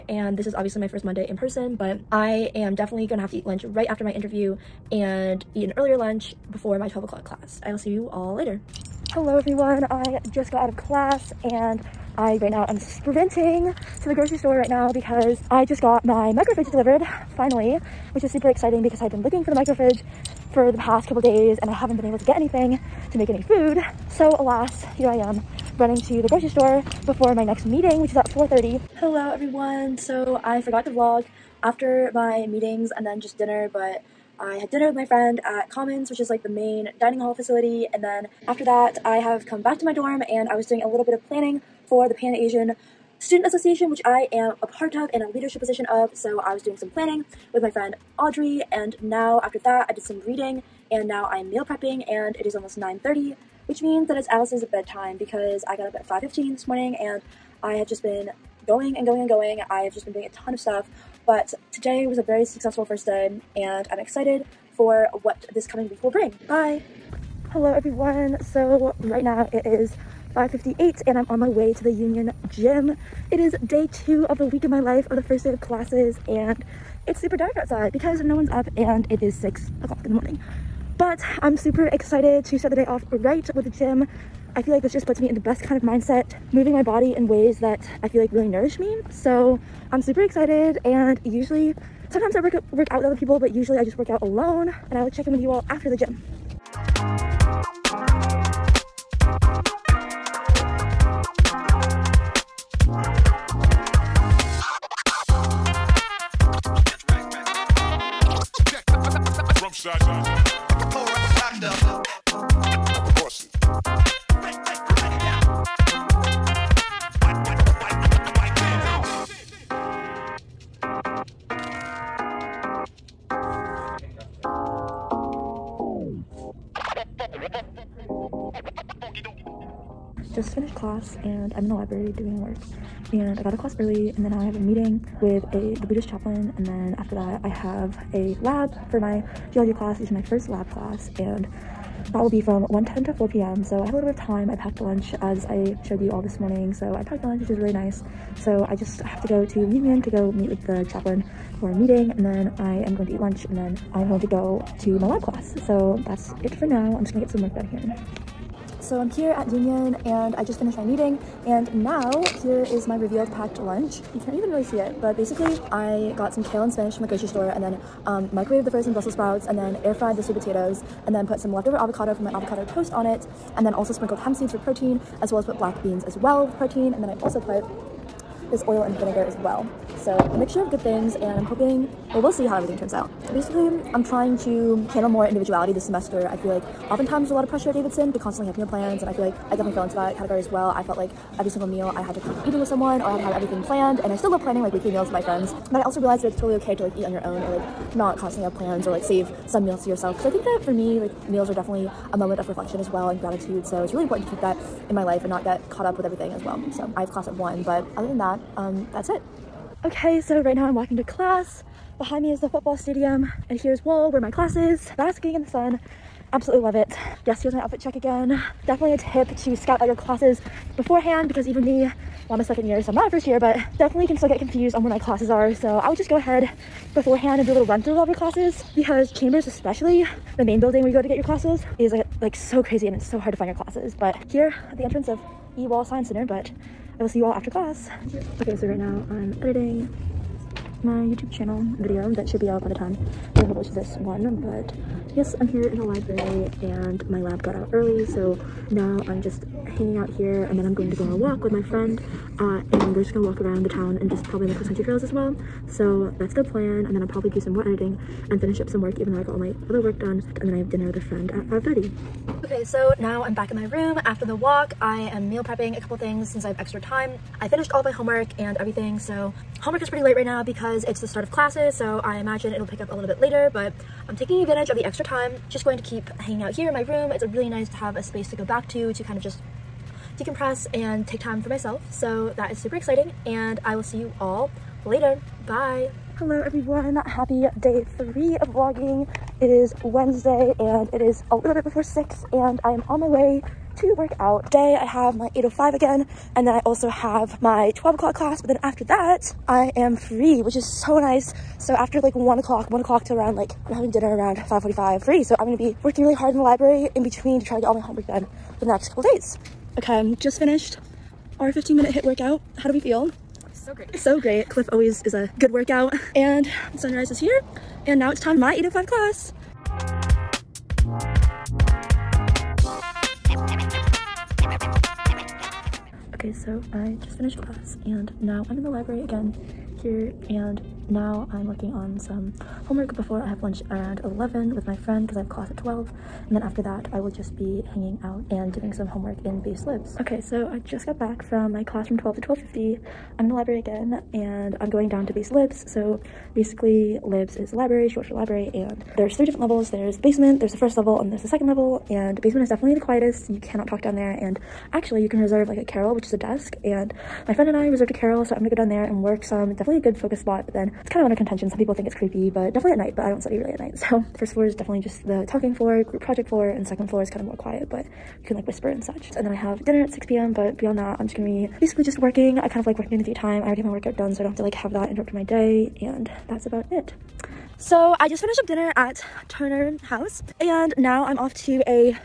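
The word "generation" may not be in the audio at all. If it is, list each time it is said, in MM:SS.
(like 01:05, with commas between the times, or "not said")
not said.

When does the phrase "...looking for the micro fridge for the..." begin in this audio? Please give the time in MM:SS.
00:19.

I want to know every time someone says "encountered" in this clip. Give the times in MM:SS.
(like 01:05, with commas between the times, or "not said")
not said.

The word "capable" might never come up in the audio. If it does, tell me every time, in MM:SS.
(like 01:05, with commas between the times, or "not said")
not said.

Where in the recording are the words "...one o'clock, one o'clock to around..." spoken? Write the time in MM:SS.
05:02.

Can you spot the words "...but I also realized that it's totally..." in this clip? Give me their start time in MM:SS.
03:15.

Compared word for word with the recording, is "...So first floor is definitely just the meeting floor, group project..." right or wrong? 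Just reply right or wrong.
wrong.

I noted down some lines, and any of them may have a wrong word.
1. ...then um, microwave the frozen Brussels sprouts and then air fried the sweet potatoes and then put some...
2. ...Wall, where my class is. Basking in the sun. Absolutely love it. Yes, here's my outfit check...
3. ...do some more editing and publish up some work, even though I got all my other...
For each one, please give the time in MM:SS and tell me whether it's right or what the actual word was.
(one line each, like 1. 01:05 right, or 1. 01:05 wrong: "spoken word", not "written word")
1. 02:47 right
2. 03:33 right
3. 04:17 wrong: "finish", not "publish".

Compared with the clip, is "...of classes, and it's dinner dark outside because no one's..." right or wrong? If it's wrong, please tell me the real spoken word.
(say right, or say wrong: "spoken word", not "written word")
wrong: "super", not "dinner".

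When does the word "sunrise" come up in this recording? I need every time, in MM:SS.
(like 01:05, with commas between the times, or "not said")
05:16.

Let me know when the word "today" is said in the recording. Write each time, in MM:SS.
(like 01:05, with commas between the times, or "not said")
01:01, 04:54.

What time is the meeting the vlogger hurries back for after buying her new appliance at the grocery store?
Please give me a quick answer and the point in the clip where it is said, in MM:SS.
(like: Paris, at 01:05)
4:30, at 00:28.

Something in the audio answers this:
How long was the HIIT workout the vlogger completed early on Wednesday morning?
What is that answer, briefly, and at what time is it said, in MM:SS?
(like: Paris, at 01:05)
15 minutes, at 05:11.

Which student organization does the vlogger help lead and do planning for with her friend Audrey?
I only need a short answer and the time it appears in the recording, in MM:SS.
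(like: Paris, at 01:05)
Pan Asian Student Association, at 00:42.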